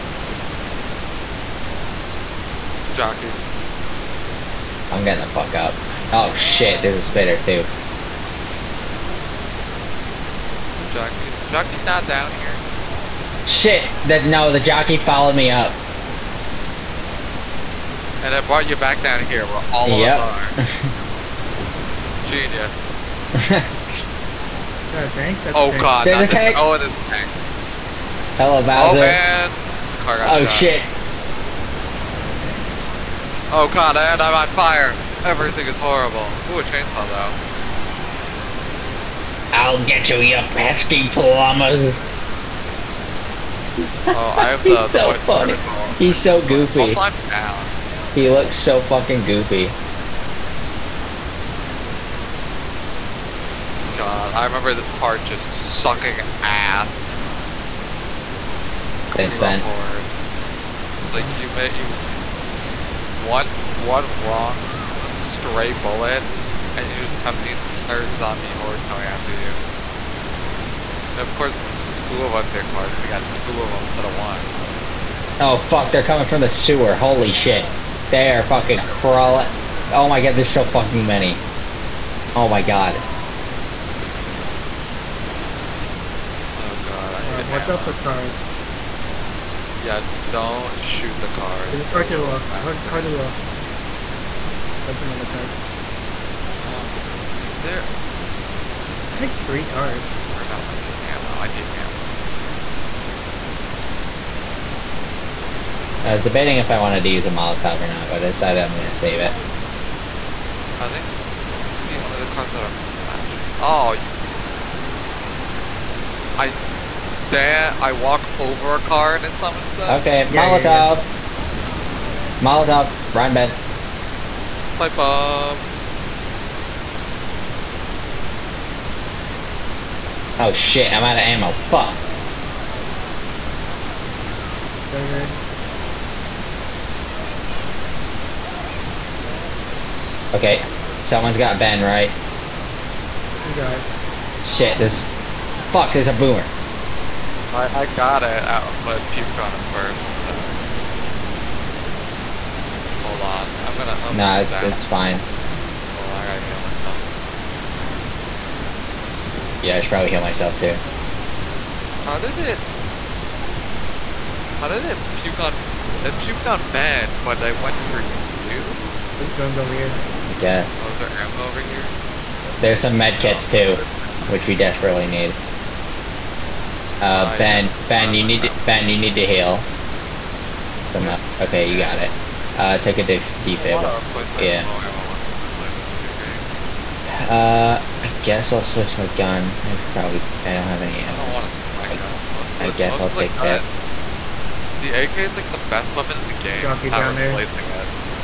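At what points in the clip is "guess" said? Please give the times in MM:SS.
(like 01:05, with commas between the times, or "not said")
02:50, 03:08, 03:12.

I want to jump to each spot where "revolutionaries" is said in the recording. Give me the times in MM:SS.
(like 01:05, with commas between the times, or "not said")
not said.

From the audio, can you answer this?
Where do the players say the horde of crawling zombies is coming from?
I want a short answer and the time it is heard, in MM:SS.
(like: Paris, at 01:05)
the sewer, at 01:16.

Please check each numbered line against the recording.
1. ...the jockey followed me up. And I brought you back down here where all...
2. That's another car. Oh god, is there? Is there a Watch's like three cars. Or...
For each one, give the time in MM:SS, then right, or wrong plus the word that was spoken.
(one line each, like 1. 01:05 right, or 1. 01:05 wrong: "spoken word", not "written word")
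1. 00:14 right
2. 01:34 wrong: "There", not "Watch".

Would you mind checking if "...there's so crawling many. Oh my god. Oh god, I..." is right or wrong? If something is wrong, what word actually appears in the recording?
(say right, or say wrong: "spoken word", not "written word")
wrong: "fucking", not "crawling".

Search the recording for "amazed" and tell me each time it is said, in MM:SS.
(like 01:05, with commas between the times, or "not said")
not said.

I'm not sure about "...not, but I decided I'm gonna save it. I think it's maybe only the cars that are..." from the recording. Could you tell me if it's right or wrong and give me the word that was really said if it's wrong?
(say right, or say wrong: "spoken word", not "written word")
right.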